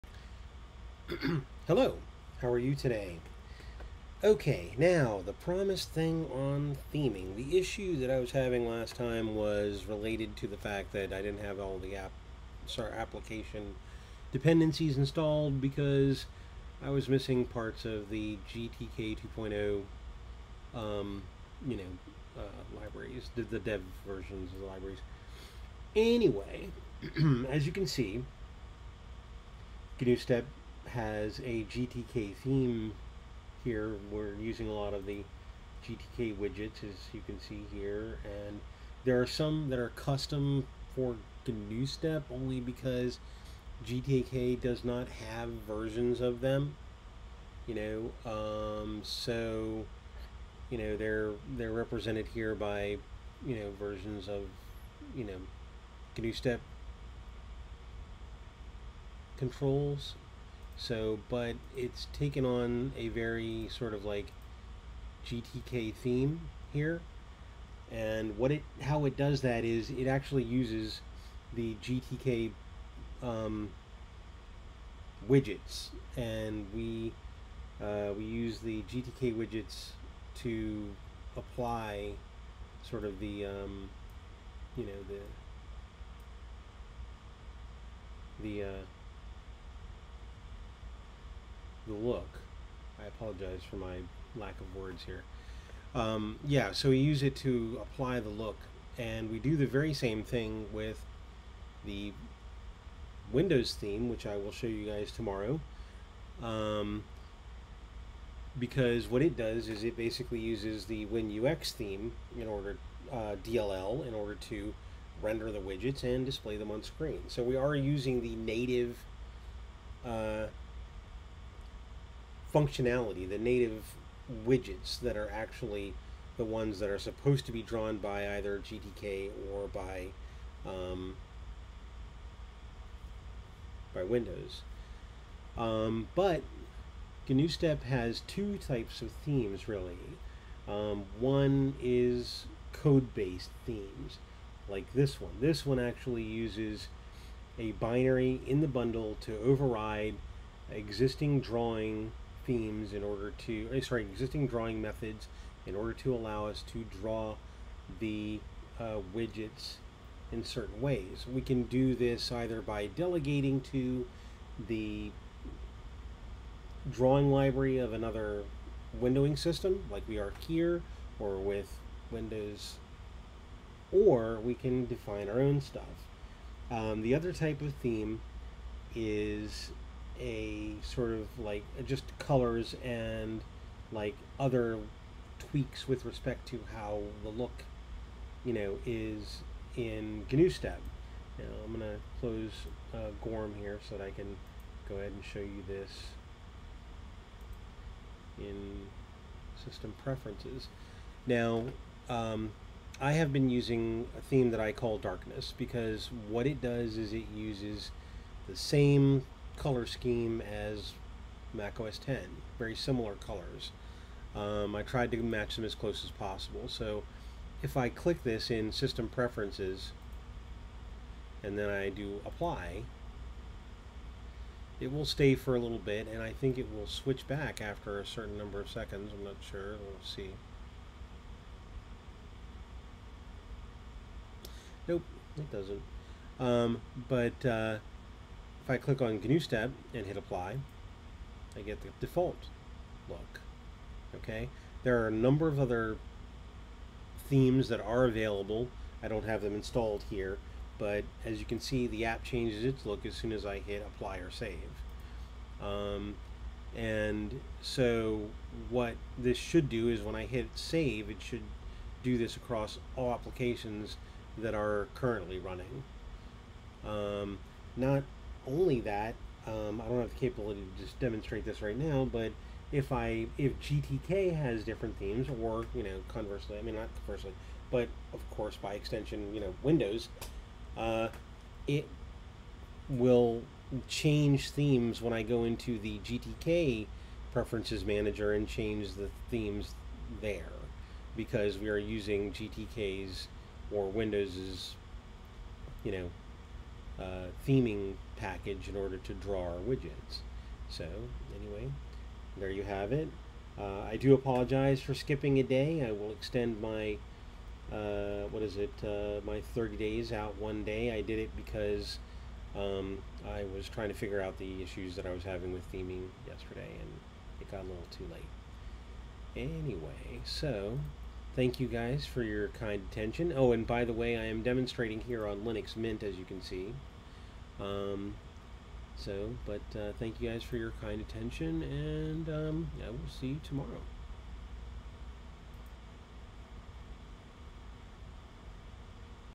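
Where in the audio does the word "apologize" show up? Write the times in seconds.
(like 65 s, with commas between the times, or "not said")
93 s, 304 s.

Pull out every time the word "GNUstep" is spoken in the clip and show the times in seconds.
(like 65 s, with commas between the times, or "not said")
41 s, 56 s, 137 s, 190 s, 239 s.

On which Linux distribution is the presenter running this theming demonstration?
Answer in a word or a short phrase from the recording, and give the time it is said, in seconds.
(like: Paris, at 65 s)
Linux Mint, at 325 s.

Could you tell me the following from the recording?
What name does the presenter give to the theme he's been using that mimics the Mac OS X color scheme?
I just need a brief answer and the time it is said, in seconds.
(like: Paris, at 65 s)
Darkness, at 204 s.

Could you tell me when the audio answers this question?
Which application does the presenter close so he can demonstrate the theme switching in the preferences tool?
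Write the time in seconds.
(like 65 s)
193 s.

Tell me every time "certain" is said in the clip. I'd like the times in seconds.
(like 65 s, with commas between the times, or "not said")
160 s, 228 s.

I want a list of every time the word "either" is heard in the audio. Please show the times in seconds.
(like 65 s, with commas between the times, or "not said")
128 s, 162 s.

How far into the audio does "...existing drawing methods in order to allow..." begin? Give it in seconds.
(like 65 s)
154 s.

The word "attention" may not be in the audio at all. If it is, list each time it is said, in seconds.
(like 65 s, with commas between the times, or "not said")
322 s, 331 s.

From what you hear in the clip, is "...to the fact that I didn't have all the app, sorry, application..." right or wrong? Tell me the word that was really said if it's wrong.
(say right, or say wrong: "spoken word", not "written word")
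right.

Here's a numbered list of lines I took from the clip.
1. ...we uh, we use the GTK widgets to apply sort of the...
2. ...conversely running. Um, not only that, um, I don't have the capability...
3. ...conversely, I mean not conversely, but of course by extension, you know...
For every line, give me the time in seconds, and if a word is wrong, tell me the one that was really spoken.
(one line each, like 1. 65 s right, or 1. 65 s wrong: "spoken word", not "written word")
1. 76 s right
2. 264 s wrong: "currently", not "conversely"
3. 276 s right.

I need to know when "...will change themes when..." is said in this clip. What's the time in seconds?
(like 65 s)
282 s.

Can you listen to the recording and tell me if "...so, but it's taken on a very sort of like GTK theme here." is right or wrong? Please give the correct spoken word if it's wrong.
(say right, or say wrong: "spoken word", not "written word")
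right.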